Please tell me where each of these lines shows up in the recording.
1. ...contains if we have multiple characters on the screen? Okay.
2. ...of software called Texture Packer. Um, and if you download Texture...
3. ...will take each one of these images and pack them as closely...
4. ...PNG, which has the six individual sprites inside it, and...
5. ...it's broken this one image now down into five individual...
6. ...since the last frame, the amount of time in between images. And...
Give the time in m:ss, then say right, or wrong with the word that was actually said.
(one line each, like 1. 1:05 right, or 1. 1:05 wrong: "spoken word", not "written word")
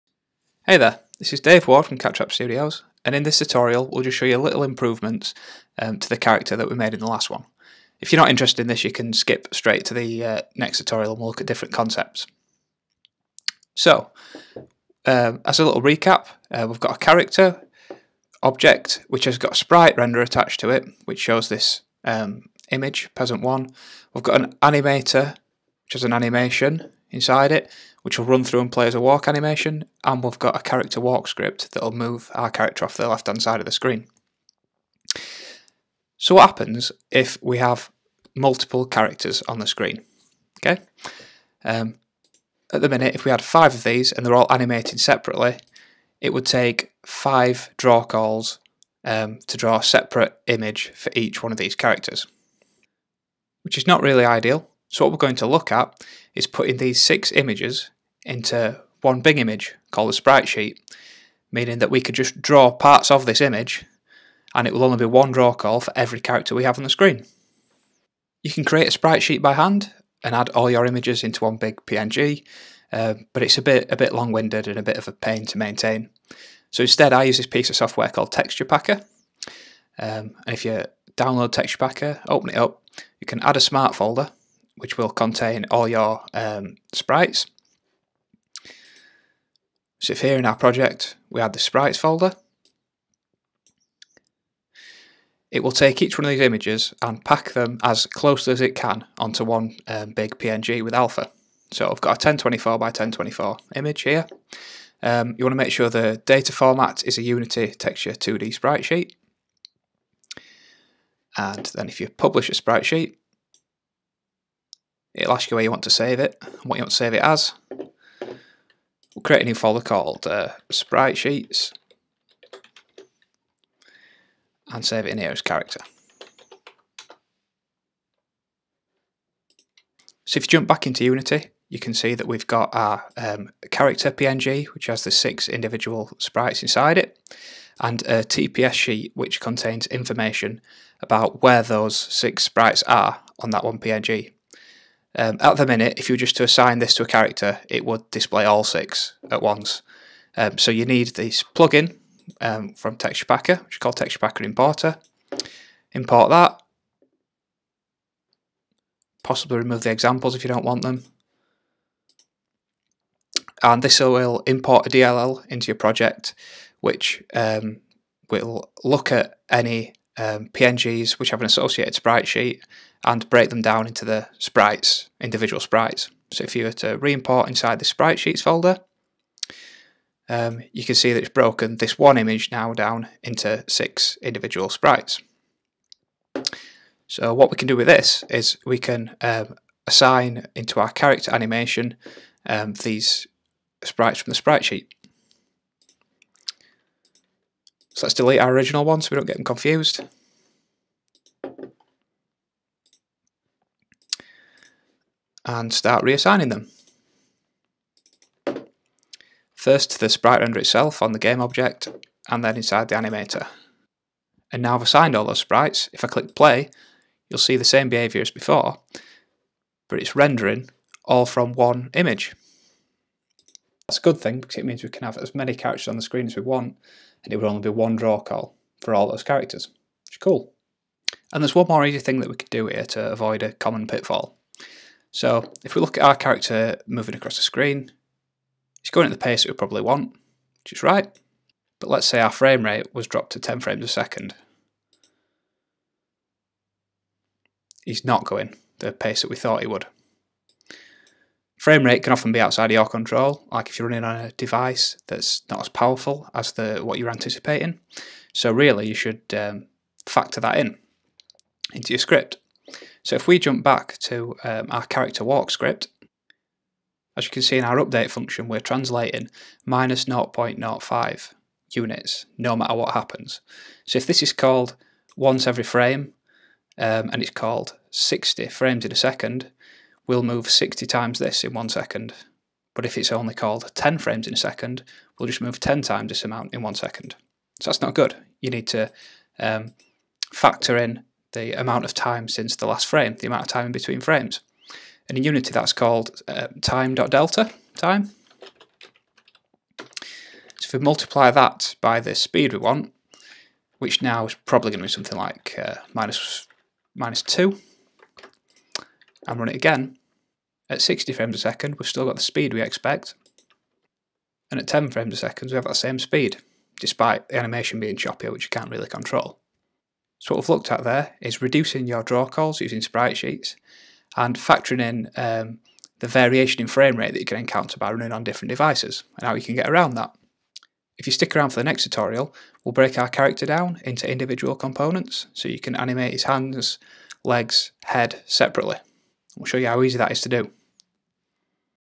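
1. 0:36 wrong: "happens", not "contains"
2. 1:17 right
3. 1:35 right
4. 2:14 right
5. 3:01 wrong: "six", not "five"
6. 4:52 wrong: "frames", not "images".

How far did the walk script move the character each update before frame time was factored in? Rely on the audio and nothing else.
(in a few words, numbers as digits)
-0.05.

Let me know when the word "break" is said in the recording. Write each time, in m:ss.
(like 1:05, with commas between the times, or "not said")
2:53, 5:32.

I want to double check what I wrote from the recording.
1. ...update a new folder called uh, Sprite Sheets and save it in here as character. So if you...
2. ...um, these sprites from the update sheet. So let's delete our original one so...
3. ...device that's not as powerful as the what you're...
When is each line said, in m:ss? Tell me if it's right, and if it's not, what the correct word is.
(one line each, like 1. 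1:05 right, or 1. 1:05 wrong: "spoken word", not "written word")
1. 1:59 wrong: "create", not "update"
2. 3:12 wrong: "sprite", not "update"
3. 4:14 right.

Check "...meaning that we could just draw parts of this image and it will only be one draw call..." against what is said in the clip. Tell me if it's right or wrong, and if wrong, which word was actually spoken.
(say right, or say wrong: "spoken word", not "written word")
right.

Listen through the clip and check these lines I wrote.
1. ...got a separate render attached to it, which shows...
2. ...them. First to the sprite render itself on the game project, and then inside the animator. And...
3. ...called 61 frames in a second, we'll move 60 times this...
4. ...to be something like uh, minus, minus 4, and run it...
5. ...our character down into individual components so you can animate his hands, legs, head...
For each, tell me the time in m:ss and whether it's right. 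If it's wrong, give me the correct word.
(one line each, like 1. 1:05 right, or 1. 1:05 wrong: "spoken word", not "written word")
1. 0:19 wrong: "sprite", not "separate"
2. 3:26 wrong: "object", not "project"
3. 4:37 wrong: "60", not "61"
4. 5:04 wrong: "2", not "4"
5. 5:32 right.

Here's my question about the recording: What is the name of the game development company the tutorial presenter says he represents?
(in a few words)
Cat Trap Studios.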